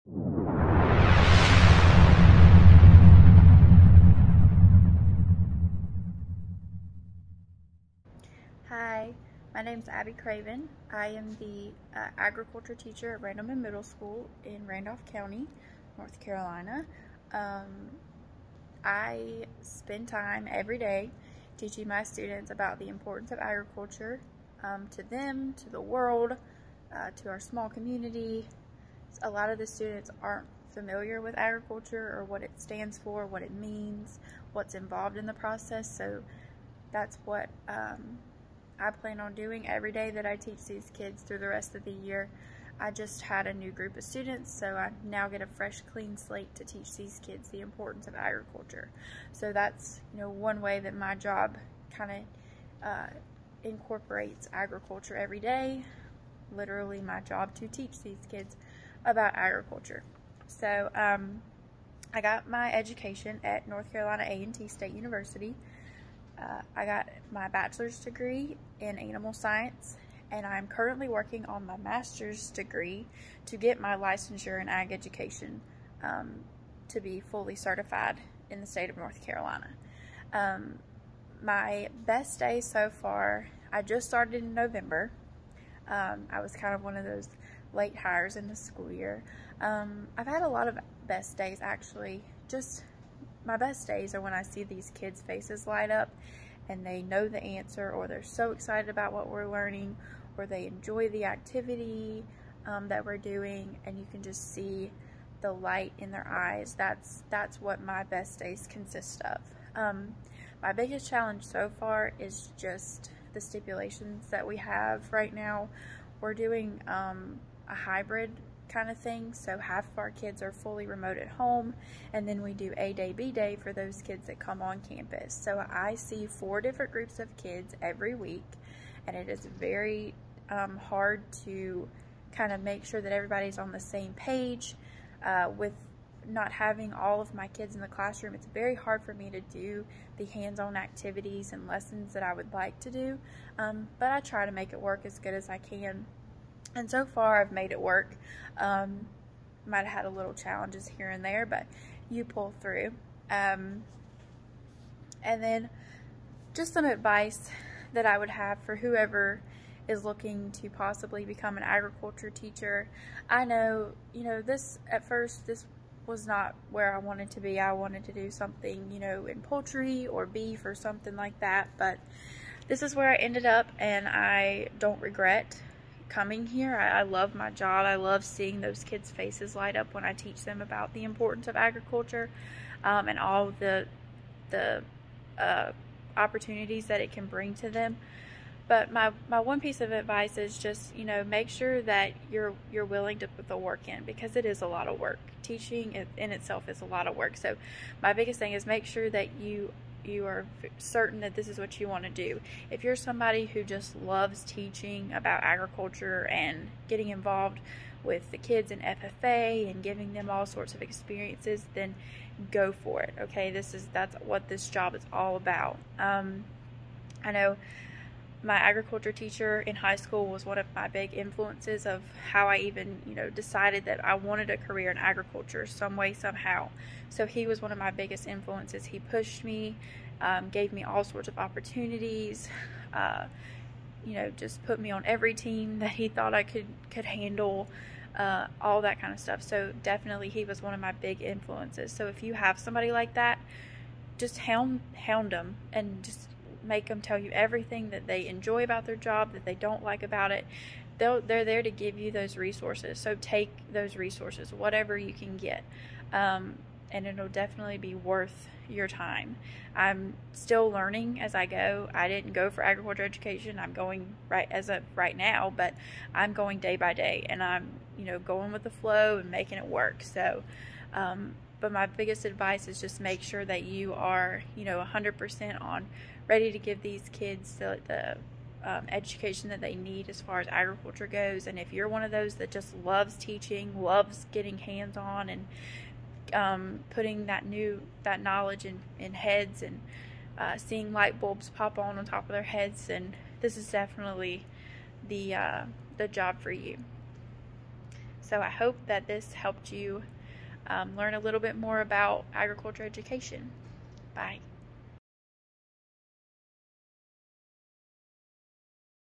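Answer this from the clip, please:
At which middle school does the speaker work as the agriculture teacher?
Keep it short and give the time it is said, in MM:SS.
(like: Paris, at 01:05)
Randleman Middle School, at 00:13.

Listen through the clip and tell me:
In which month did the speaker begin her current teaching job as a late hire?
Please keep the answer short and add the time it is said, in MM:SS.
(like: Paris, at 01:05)
November, at 01:24.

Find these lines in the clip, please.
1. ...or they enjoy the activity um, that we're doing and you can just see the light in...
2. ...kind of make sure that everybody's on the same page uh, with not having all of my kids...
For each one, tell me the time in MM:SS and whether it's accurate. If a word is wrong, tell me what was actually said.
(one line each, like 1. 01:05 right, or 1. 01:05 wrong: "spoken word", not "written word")
1. 01:40 right
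2. 02:12 right.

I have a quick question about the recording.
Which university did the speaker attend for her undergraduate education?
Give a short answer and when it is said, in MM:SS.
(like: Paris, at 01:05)
North Carolina A&T State University, at 01:03.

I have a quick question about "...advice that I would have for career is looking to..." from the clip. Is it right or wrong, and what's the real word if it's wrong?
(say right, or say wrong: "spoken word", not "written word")
wrong: "whoever", not "career".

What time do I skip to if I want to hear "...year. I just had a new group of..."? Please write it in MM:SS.
00:41.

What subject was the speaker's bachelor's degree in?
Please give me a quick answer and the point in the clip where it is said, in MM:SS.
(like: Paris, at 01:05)
Animal science, at 01:08.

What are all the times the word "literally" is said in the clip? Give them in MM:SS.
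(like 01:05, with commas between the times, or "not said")
00:56.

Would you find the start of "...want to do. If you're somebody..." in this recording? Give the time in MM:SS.
03:21.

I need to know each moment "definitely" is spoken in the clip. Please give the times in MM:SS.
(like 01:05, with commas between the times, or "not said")
03:59, 04:17, 04:53.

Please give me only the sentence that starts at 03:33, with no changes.
Okay, this is that's what this job is all about.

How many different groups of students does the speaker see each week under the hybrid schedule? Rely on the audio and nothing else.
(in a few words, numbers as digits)
4.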